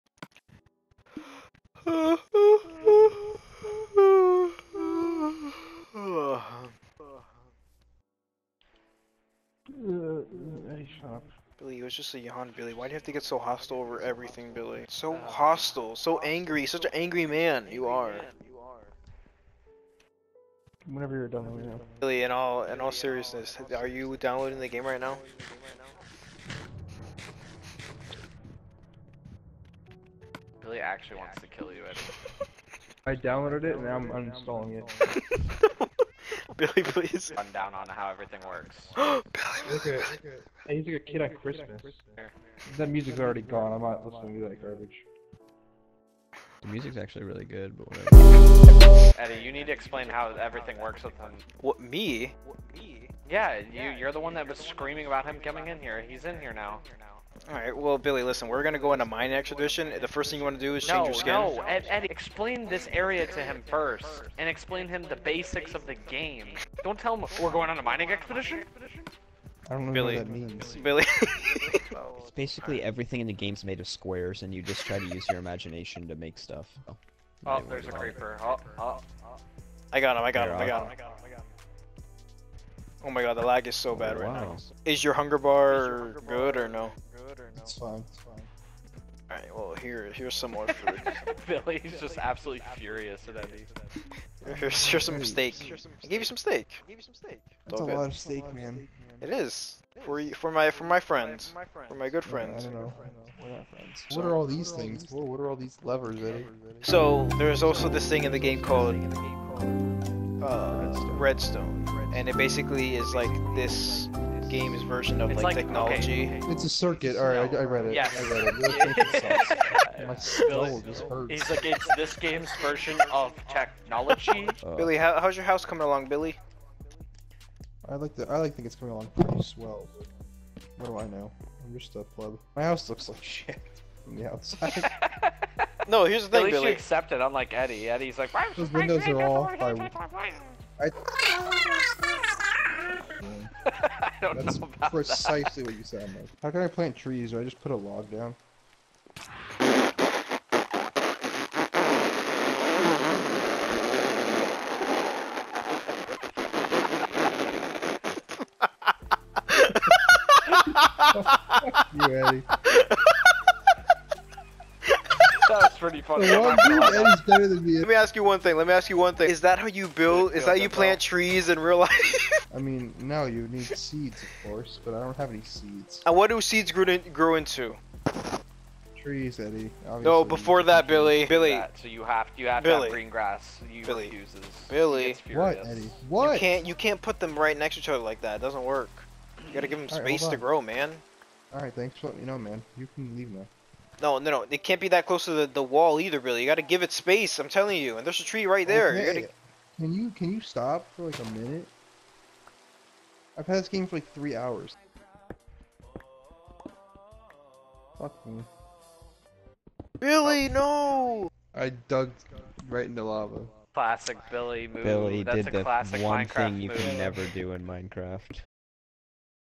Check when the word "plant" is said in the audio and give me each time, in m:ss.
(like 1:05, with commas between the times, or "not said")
2:26, 2:50.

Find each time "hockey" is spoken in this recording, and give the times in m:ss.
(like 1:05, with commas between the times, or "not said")
not said.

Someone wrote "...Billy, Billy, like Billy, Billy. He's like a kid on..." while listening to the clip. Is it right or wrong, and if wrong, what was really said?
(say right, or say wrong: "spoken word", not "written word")
right.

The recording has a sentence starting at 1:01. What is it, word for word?
No, Ed, Eddie, explain this area to him first, and explain him the basics of the game.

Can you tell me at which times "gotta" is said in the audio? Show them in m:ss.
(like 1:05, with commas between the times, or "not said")
3:09, 3:19.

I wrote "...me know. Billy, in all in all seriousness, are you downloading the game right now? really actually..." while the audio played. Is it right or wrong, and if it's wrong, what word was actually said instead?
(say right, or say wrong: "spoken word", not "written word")
right.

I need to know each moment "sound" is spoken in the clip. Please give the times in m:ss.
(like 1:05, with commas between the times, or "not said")
2:25.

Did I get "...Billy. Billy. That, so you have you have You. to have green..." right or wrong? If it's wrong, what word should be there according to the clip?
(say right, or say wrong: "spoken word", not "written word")
wrong: "Billy", not "You".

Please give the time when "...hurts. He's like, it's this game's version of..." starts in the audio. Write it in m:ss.
2:01.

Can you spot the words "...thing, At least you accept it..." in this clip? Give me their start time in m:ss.
2:16.